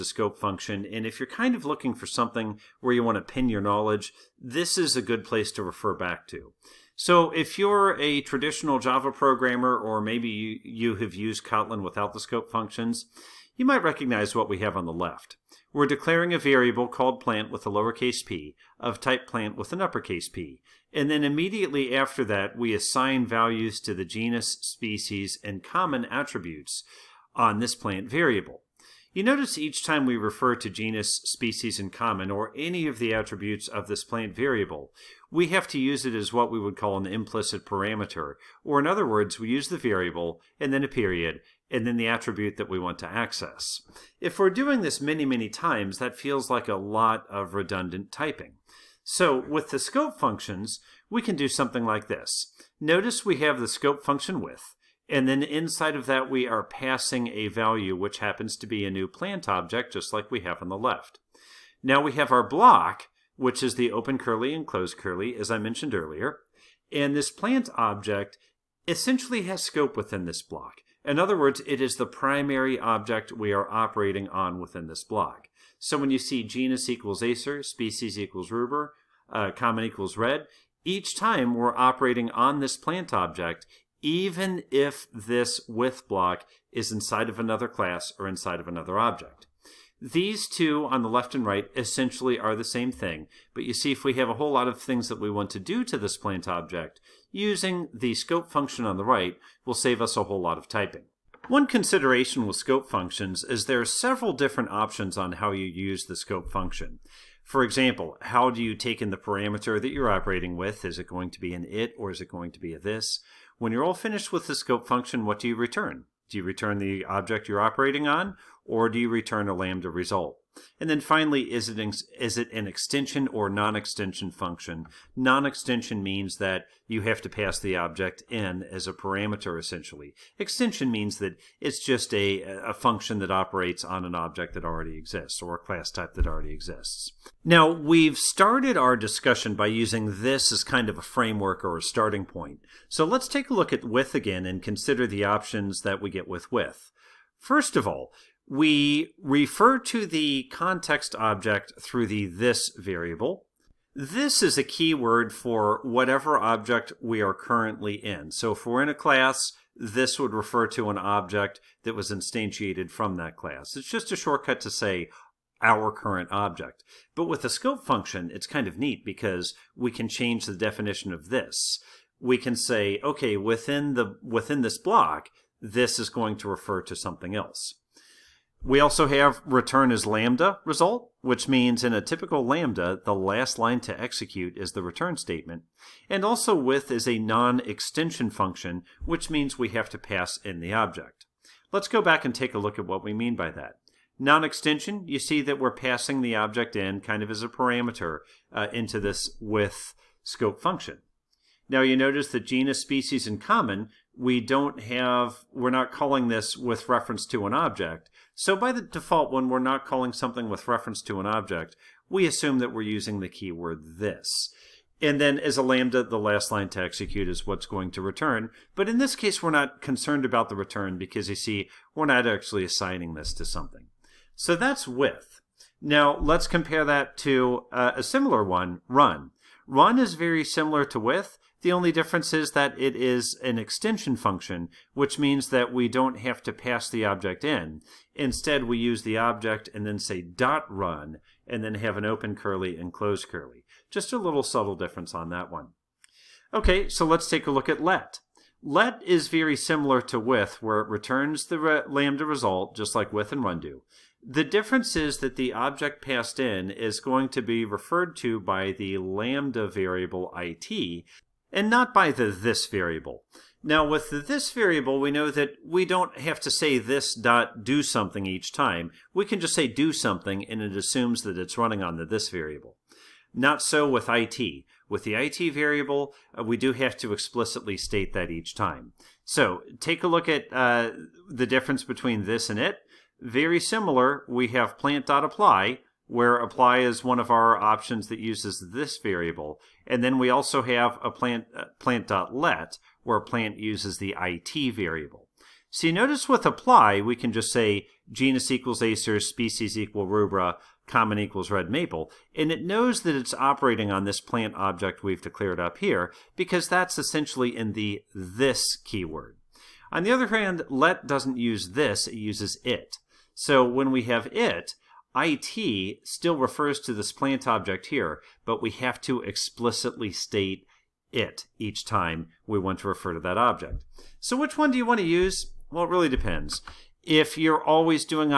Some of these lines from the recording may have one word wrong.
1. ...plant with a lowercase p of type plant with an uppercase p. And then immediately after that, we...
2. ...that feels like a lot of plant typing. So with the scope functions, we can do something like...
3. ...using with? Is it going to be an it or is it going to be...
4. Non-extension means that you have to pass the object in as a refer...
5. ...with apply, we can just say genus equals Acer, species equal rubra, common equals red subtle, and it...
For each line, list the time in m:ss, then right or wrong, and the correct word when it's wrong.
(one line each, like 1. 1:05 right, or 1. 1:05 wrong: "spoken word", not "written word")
1. 0:17 right
2. 0:45 wrong: "redundant", not "plant"
3. 1:50 wrong: "operating", not "using"
4. 2:05 wrong: "parameter", not "refer"
5. 4:56 wrong: "maple", not "subtle".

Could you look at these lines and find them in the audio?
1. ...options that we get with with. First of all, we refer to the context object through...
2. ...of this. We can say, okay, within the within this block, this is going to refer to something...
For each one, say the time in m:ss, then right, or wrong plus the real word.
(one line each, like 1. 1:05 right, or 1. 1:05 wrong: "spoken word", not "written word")
1. 2:25 right
2. 2:51 right.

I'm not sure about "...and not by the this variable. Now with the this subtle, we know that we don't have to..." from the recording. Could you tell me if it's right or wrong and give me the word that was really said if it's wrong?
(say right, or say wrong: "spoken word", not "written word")
wrong: "variable", not "subtle".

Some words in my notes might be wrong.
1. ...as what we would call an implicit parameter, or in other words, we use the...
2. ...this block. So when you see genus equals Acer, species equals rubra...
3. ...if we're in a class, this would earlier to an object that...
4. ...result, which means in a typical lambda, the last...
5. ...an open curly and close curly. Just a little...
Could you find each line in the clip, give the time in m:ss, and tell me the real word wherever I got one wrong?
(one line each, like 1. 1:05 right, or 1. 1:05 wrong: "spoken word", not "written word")
1. 0:36 right
2. 1:14 right
3. 2:38 wrong: "refer", not "earlier"
4. 3:00 right
5. 4:01 right.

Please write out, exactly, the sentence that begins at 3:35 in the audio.
And then as a lambda, the last line to execute is what's going to return.